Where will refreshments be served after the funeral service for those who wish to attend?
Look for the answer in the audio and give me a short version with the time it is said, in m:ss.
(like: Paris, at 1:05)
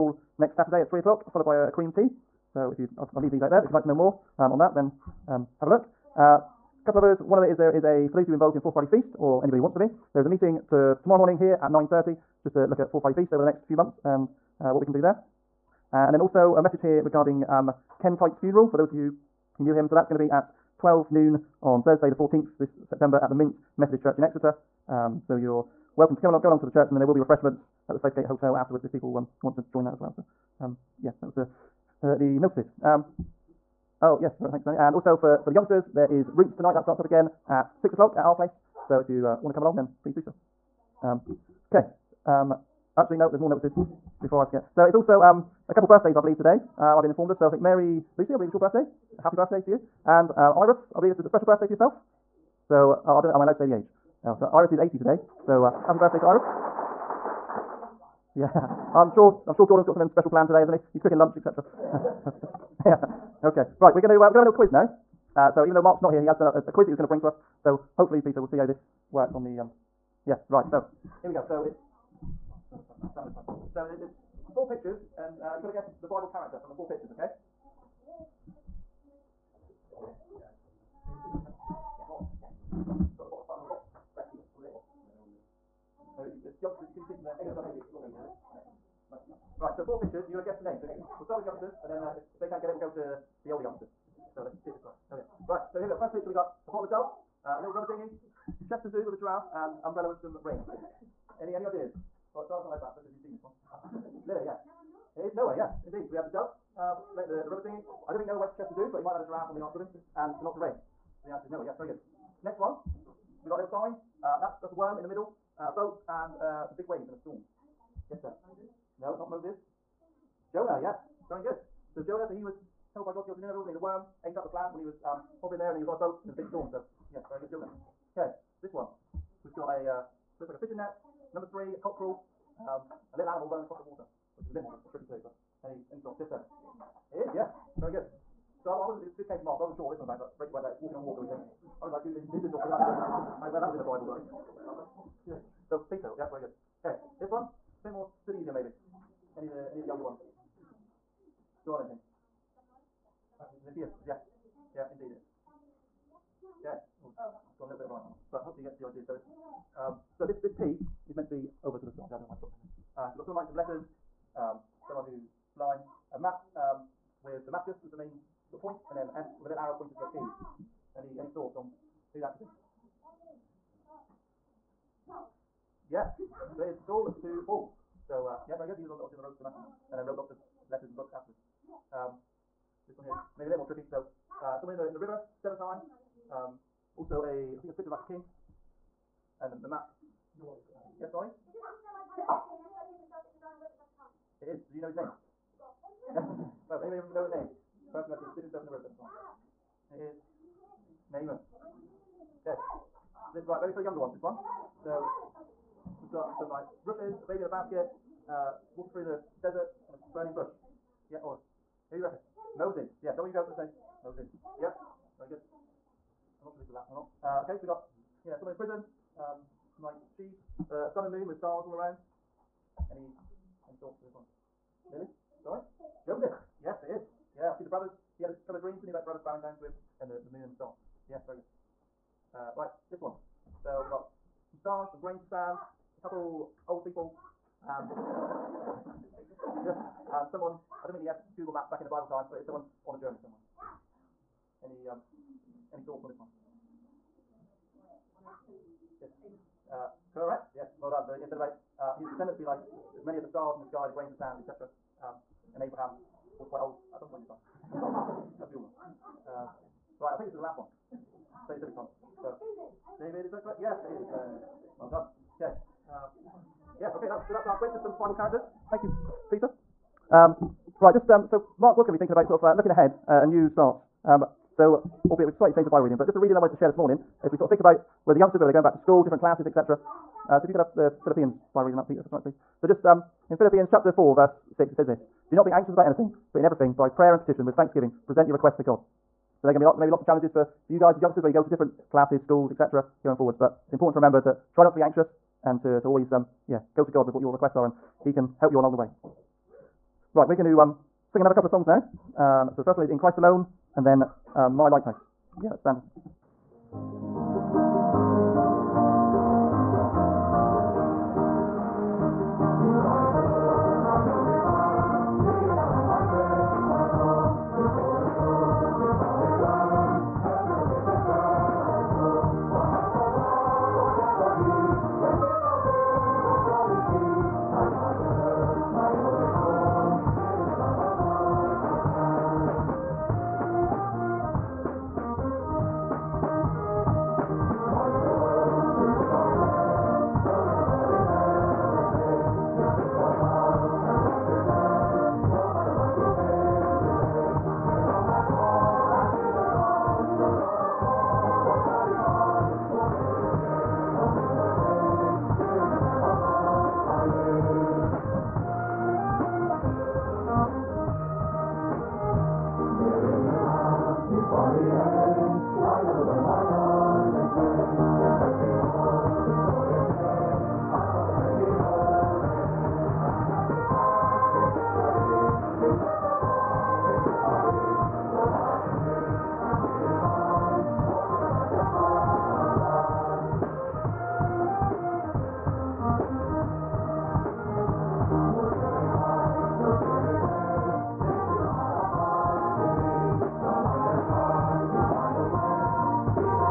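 Safegate Hotel, at 0:27.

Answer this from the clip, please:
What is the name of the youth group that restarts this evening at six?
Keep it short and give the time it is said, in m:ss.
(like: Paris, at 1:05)
Roots, at 0:36.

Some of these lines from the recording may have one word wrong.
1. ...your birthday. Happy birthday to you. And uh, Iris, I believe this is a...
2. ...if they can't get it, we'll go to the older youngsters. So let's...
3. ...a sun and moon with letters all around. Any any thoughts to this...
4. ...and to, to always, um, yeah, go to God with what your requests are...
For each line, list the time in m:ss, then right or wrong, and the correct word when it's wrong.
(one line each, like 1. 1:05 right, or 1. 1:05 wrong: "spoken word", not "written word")
1. 0:48 right
2. 1:32 right
3. 3:40 wrong: "stars", not "letters"
4. 4:55 right.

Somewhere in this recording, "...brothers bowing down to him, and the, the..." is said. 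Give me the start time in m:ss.
3:49.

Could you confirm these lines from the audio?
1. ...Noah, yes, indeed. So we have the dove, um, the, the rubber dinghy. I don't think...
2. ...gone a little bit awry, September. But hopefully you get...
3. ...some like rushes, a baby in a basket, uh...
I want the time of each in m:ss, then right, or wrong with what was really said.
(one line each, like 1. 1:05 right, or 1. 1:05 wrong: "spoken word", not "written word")
1. 1:45 right
2. 2:37 wrong: "Mama", not "September"
3. 3:26 right.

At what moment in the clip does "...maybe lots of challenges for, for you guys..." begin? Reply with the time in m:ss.
4:49.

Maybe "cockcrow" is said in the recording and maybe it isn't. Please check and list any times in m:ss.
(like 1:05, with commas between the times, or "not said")
2:11.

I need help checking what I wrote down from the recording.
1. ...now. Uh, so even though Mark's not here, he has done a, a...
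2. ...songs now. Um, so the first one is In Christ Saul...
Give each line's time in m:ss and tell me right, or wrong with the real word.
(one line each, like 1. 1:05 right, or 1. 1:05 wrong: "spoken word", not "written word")
1. 1:04 right
2. 5:01 wrong: "Alone", not "Saul".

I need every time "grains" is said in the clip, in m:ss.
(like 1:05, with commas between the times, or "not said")
3:55, 4:13.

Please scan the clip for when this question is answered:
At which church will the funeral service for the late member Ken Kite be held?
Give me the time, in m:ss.
0:23.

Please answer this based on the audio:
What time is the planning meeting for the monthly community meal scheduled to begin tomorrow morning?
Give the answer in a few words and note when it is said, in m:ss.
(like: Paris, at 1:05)
9:30, at 0:11.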